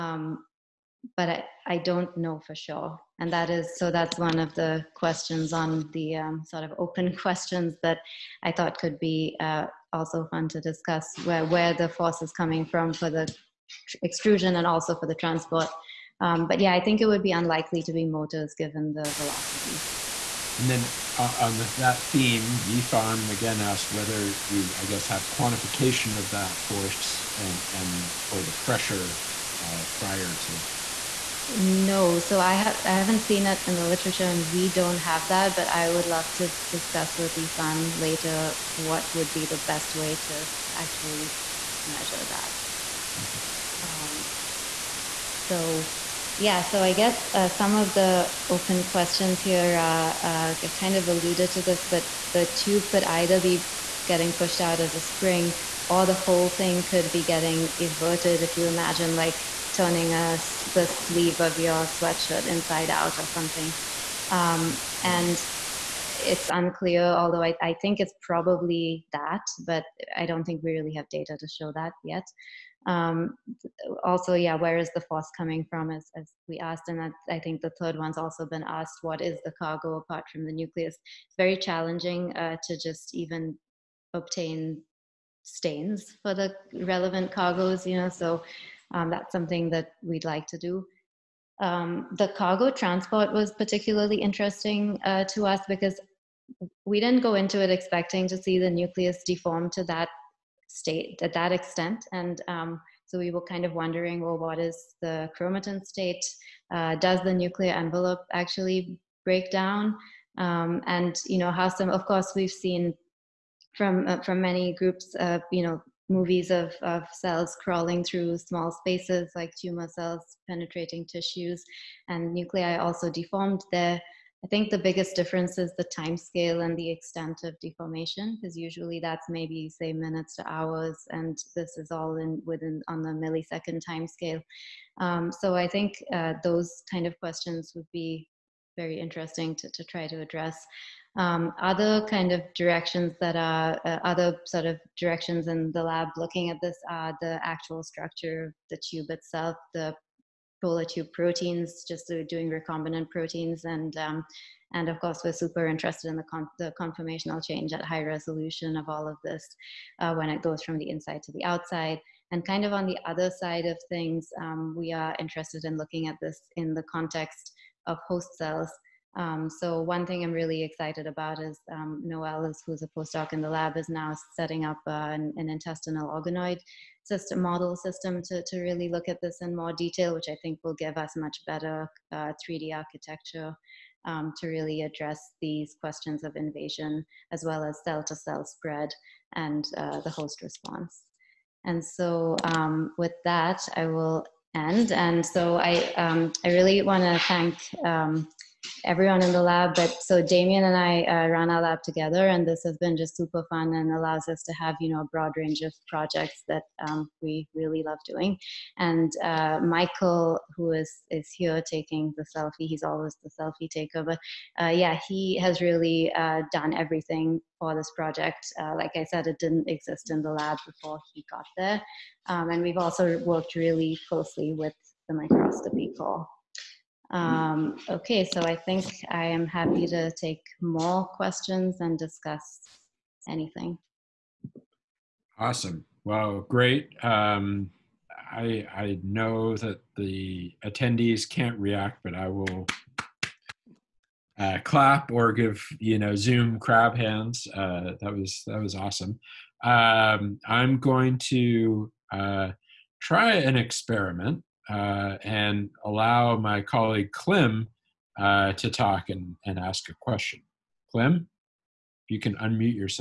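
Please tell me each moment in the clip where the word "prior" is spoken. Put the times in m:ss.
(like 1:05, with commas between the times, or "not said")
0:29.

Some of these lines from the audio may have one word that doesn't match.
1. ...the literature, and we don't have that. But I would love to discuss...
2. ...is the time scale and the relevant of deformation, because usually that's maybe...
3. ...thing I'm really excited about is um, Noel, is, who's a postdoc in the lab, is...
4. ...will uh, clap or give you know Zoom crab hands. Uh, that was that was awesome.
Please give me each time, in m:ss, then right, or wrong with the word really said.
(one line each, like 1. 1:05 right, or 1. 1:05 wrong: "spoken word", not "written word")
1. 0:33 right
2. 2:05 wrong: "extent", not "relevant"
3. 2:50 right
4. 4:02 right.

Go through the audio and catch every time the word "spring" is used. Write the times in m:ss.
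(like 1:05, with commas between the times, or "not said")
0:55.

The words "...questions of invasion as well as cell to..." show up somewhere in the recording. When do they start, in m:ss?
3:05.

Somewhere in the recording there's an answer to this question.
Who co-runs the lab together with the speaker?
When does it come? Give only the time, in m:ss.
3:20.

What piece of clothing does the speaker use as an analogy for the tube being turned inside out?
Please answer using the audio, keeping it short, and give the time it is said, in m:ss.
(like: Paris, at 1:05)
sweatshirt, at 1:01.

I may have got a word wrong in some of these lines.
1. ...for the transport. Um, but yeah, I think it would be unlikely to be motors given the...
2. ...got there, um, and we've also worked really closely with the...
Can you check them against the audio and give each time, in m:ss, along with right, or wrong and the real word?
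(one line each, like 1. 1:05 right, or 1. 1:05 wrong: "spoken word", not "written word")
1. 0:14 right
2. 3:41 right.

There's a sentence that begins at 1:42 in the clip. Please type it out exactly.
And um, so we were kind of wondering, well, what is the chromatin state?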